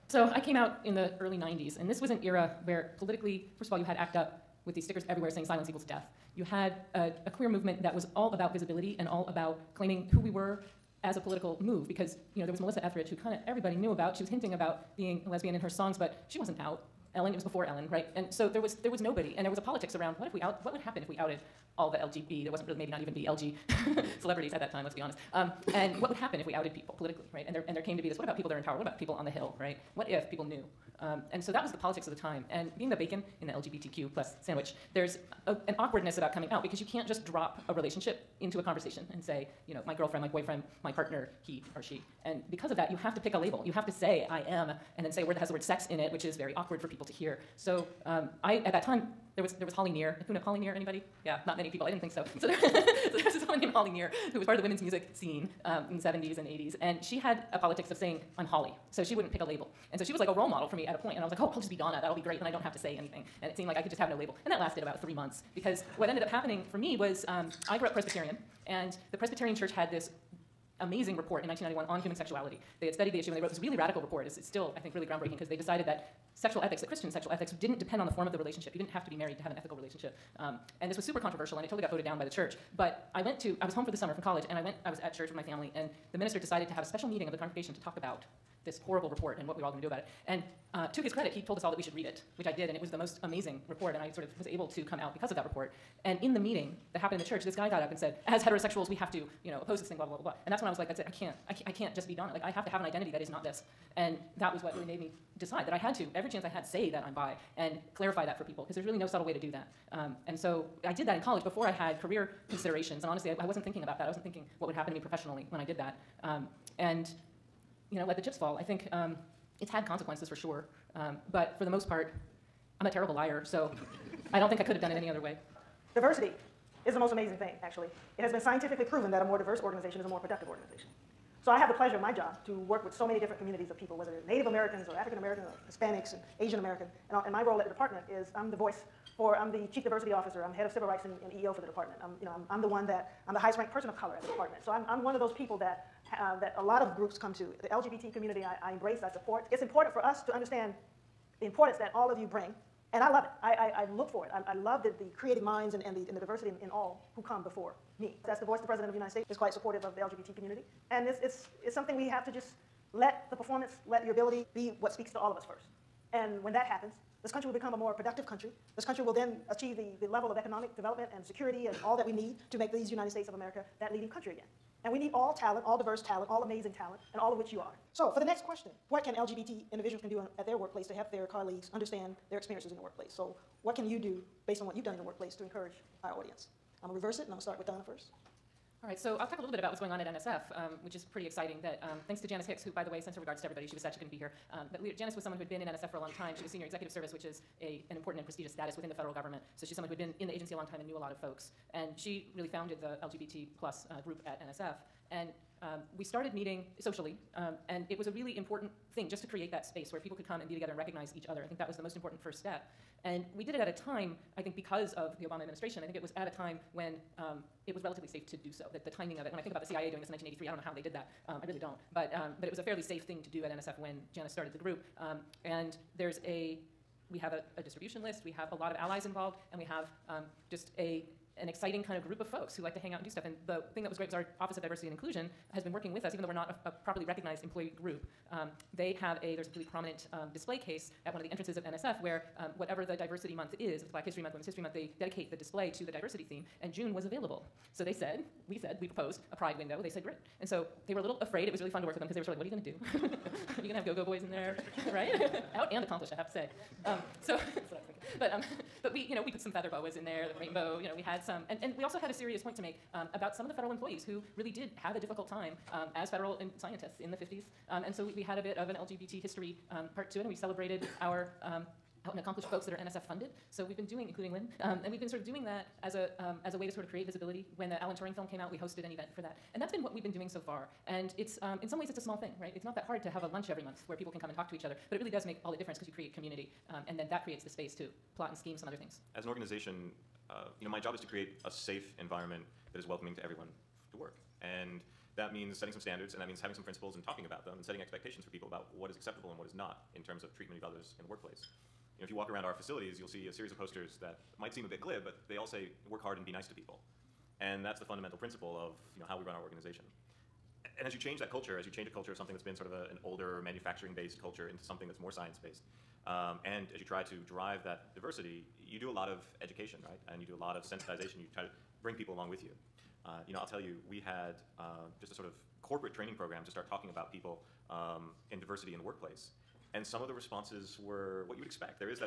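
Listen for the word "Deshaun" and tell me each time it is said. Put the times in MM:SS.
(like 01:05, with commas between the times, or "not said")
not said.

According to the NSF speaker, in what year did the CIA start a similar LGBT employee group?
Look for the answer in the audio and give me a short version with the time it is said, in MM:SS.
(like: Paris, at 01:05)
1983, at 03:40.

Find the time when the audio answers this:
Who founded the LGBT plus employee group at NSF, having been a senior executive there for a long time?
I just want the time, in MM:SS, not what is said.
03:12.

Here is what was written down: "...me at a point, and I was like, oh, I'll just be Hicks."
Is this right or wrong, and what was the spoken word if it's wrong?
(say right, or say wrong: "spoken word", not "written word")
wrong: "Donna", not "Hicks".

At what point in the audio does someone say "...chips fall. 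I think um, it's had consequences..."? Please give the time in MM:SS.
01:58.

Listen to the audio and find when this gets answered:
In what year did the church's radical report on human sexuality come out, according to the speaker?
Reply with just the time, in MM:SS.
01:11.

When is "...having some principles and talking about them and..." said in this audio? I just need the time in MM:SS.
04:56.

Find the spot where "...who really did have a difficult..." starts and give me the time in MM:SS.
04:24.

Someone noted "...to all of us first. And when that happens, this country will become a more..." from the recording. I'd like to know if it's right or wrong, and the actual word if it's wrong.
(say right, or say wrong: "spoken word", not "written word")
right.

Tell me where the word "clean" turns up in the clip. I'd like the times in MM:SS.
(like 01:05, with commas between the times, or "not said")
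not said.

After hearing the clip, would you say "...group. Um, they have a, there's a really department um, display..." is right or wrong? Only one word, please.
wrong.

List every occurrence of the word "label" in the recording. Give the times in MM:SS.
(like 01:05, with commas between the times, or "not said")
00:43, 00:59, 01:04.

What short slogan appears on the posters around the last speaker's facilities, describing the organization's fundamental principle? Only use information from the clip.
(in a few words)
Work hard and be nice to people.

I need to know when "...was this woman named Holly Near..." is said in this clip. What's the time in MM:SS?
00:53.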